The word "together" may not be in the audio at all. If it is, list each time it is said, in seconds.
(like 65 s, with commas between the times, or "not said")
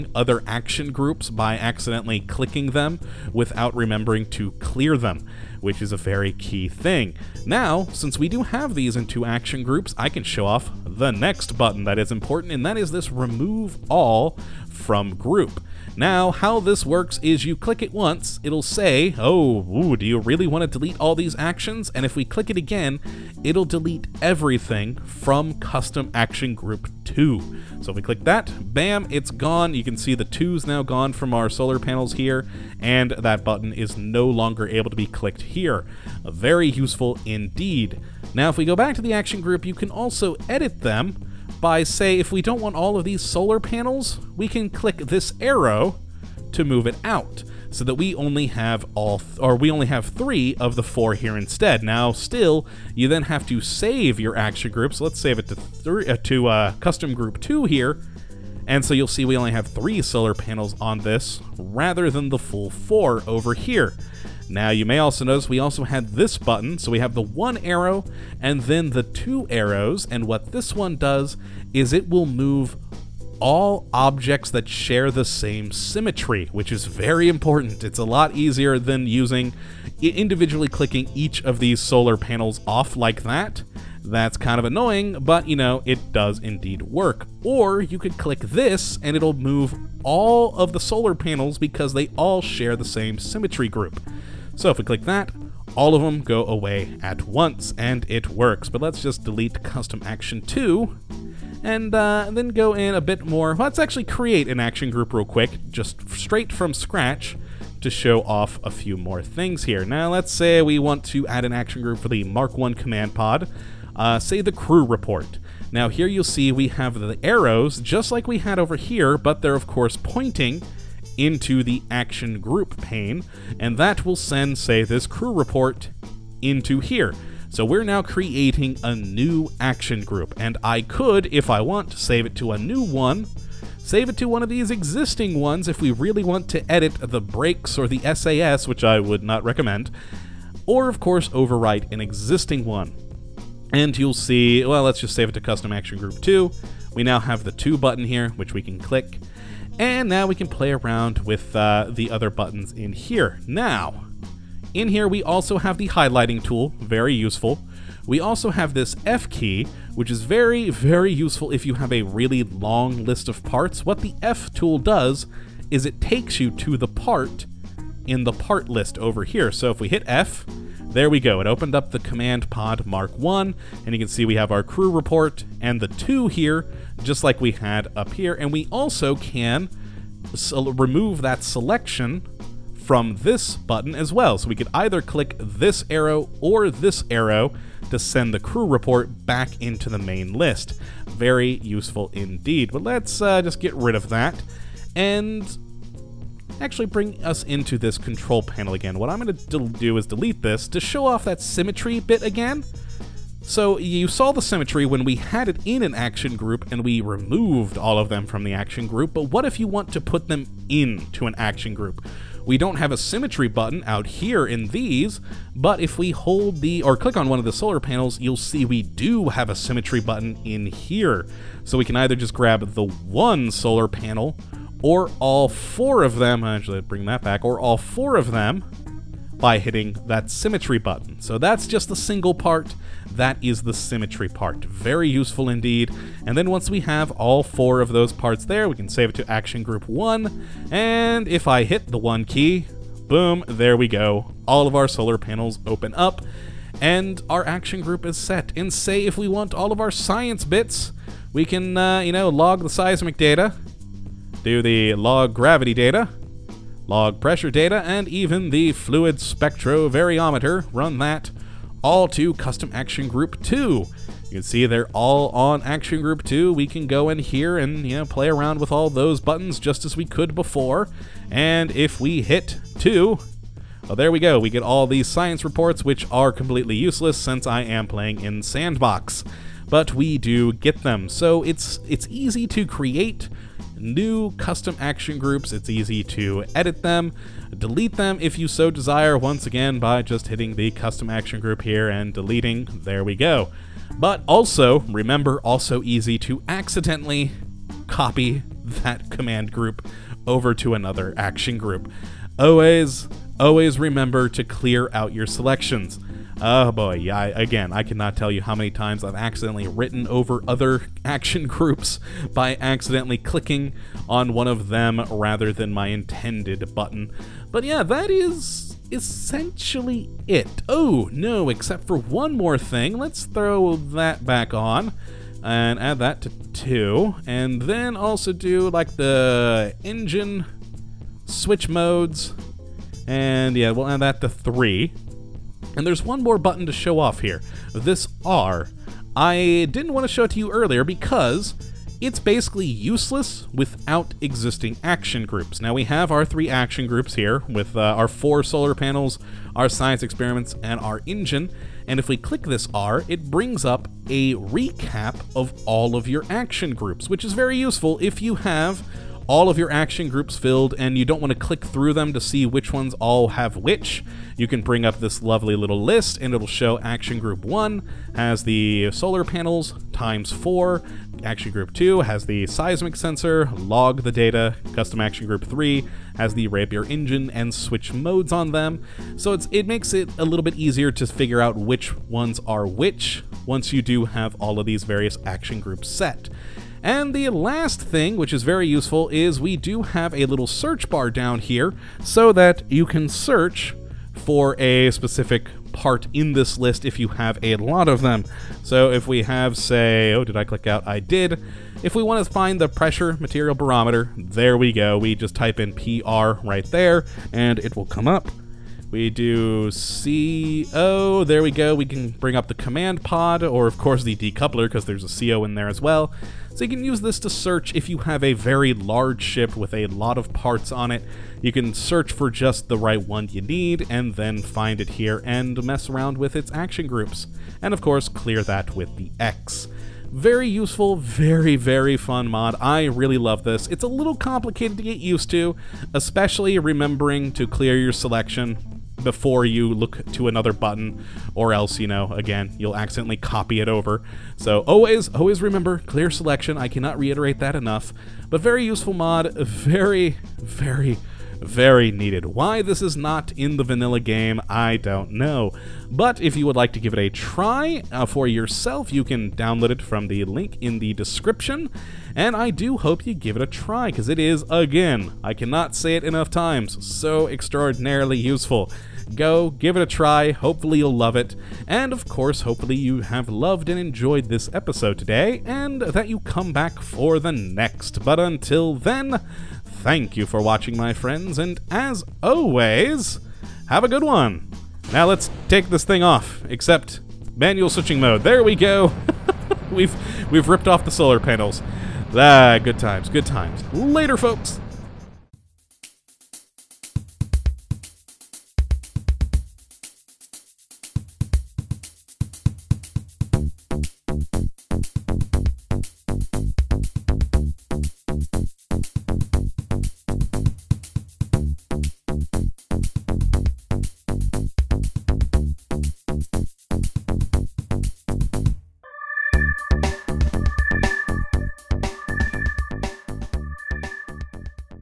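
not said.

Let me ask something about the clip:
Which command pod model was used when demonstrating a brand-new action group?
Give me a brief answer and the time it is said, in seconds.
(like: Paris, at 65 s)
Mark 1, at 112 s.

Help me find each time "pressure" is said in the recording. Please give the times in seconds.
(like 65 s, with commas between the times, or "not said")
257 s, 402 s.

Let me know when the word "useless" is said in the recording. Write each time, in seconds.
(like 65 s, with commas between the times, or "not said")
276 s, 342 s.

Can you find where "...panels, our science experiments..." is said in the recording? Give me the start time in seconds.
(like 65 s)
348 s.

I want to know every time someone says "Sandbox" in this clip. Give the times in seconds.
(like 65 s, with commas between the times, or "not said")
278 s.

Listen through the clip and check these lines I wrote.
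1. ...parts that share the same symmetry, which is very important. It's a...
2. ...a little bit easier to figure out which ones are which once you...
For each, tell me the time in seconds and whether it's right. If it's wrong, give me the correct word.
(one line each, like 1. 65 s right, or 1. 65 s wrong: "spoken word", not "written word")
1. 73 s wrong: "objects", not "parts"
2. 380 s right.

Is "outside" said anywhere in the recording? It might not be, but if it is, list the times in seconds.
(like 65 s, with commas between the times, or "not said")
not said.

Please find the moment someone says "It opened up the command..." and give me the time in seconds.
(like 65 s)
171 s.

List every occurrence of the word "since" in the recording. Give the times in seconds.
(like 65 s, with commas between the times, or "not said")
7 s, 277 s.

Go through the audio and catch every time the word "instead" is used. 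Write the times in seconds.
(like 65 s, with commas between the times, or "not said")
51 s.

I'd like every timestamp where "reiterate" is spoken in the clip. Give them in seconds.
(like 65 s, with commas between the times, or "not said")
446 s.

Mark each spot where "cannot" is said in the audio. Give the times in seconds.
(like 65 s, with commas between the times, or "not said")
307 s, 446 s, 465 s.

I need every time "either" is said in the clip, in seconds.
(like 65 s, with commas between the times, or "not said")
184 s, 221 s.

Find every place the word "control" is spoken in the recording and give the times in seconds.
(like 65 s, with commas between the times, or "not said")
197 s.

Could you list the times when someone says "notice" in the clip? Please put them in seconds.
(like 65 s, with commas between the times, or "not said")
65 s.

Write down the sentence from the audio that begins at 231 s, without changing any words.
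So that's just the single part.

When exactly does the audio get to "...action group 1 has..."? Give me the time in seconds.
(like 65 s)
366 s.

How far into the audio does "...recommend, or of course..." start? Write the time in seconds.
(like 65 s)
139 s.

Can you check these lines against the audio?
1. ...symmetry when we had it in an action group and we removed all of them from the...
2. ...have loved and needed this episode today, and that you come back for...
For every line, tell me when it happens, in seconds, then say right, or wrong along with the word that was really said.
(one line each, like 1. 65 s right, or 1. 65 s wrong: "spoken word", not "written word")
1. 204 s right
2. 473 s wrong: "enjoyed", not "needed".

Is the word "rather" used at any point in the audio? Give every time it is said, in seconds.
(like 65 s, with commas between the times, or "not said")
61 s, 315 s.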